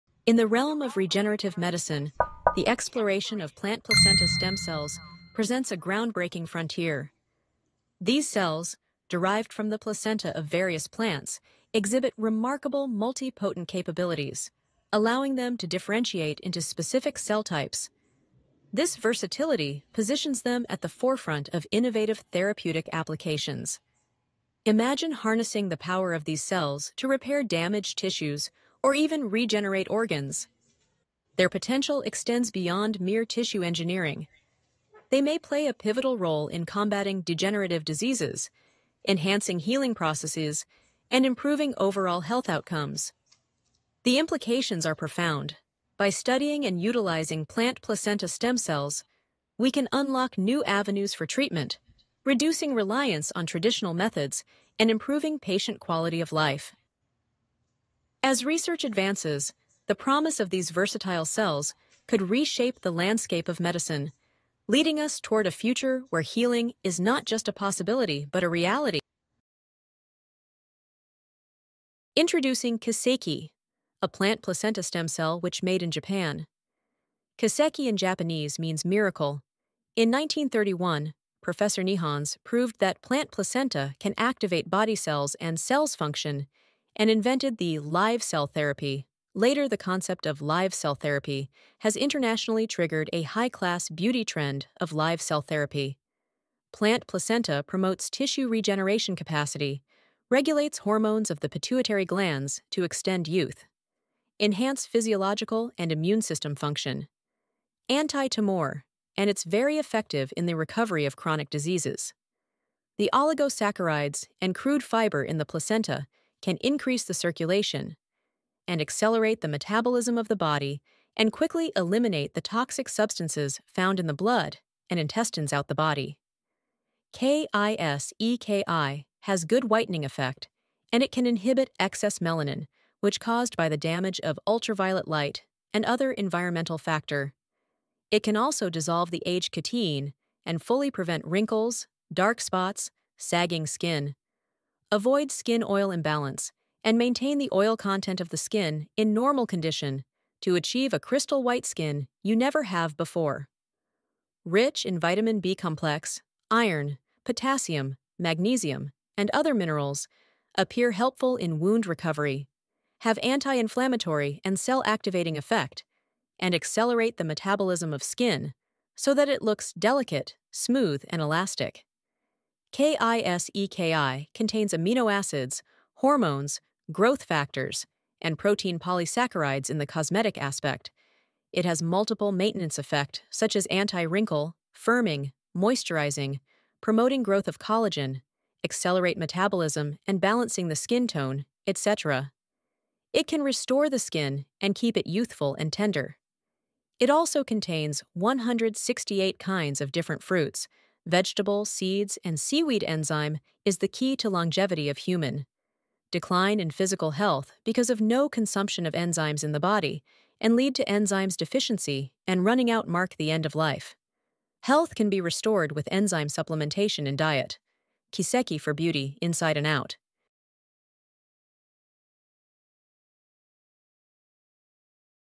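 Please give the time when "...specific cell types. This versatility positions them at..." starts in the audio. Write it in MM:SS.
00:16.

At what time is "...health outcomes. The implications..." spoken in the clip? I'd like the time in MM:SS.
00:42.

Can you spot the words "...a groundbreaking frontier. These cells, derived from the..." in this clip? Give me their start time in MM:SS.
00:05.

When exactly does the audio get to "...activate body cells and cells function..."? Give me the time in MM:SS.
01:24.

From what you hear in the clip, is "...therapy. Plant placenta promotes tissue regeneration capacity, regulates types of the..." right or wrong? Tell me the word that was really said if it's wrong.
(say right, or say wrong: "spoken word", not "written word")
wrong: "hormones", not "types".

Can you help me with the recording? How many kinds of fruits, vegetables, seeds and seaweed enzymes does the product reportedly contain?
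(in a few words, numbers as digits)
168.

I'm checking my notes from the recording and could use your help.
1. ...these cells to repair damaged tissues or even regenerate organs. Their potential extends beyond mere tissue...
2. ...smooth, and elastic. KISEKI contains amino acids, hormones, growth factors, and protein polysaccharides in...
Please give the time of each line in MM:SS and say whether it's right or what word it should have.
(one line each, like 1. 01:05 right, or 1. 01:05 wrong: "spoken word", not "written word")
1. 00:26 right
2. 02:50 right.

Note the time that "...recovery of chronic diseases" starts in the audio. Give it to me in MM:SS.
01:50.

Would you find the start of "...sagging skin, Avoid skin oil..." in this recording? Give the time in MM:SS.
02:23.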